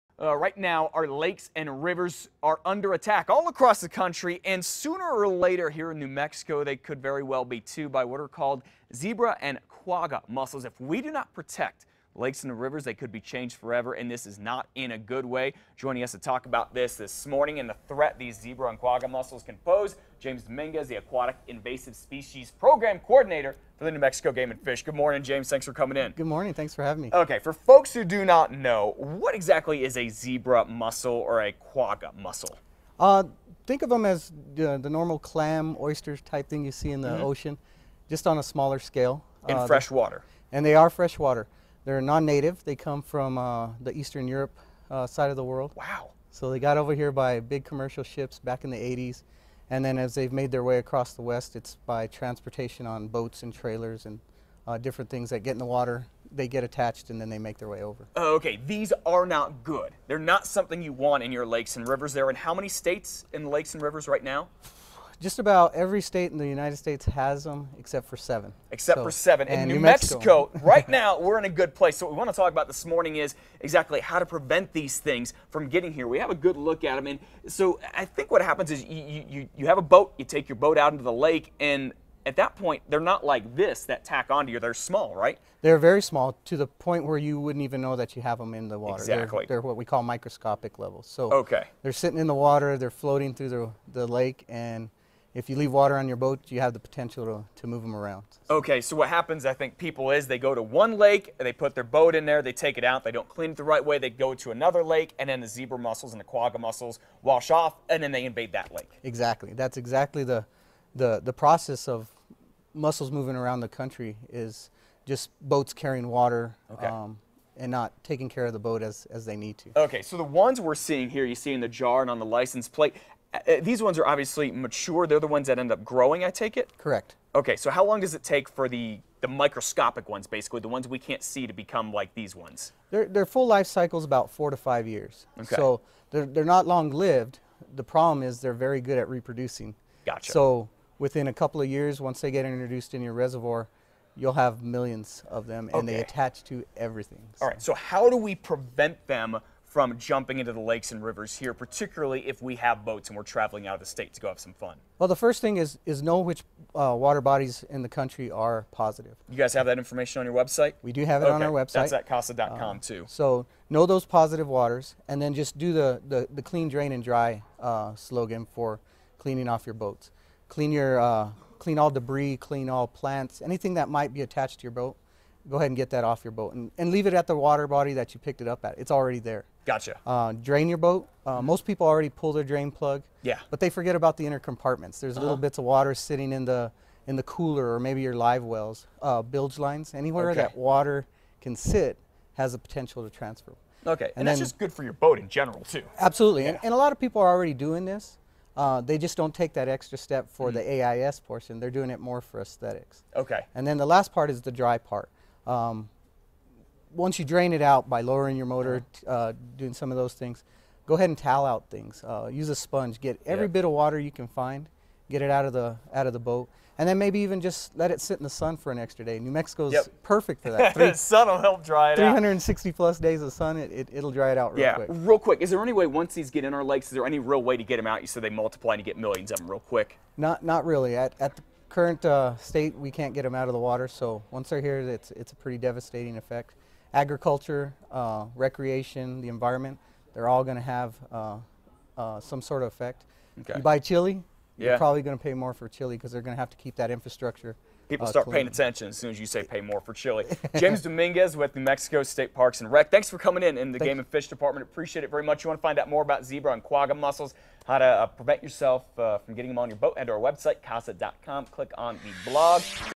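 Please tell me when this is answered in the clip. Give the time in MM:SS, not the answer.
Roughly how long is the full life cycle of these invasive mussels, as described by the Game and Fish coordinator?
02:14.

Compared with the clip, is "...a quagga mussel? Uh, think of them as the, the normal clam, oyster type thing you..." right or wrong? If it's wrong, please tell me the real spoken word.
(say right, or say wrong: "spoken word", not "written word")
right.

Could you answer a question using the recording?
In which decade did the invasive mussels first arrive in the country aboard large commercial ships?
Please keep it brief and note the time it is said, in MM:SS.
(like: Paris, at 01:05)
the 80s, at 00:48.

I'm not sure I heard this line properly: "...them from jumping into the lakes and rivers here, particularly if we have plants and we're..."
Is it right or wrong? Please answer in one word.
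wrong.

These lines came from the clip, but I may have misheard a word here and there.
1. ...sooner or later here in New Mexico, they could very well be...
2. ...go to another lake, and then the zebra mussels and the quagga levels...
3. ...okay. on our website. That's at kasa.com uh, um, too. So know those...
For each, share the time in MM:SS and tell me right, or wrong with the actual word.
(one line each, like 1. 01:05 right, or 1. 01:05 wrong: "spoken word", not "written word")
1. 00:04 right
2. 01:44 wrong: "mussels", not "levels"
3. 02:41 right.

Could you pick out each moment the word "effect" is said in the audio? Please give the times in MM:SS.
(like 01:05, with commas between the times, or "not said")
03:56, 04:02.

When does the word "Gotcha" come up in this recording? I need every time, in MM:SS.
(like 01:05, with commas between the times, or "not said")
02:20, 02:59.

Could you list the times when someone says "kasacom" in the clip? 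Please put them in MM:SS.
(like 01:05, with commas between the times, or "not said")
02:42, 04:20.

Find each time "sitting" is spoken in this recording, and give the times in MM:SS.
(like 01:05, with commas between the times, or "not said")
01:31, 03:05.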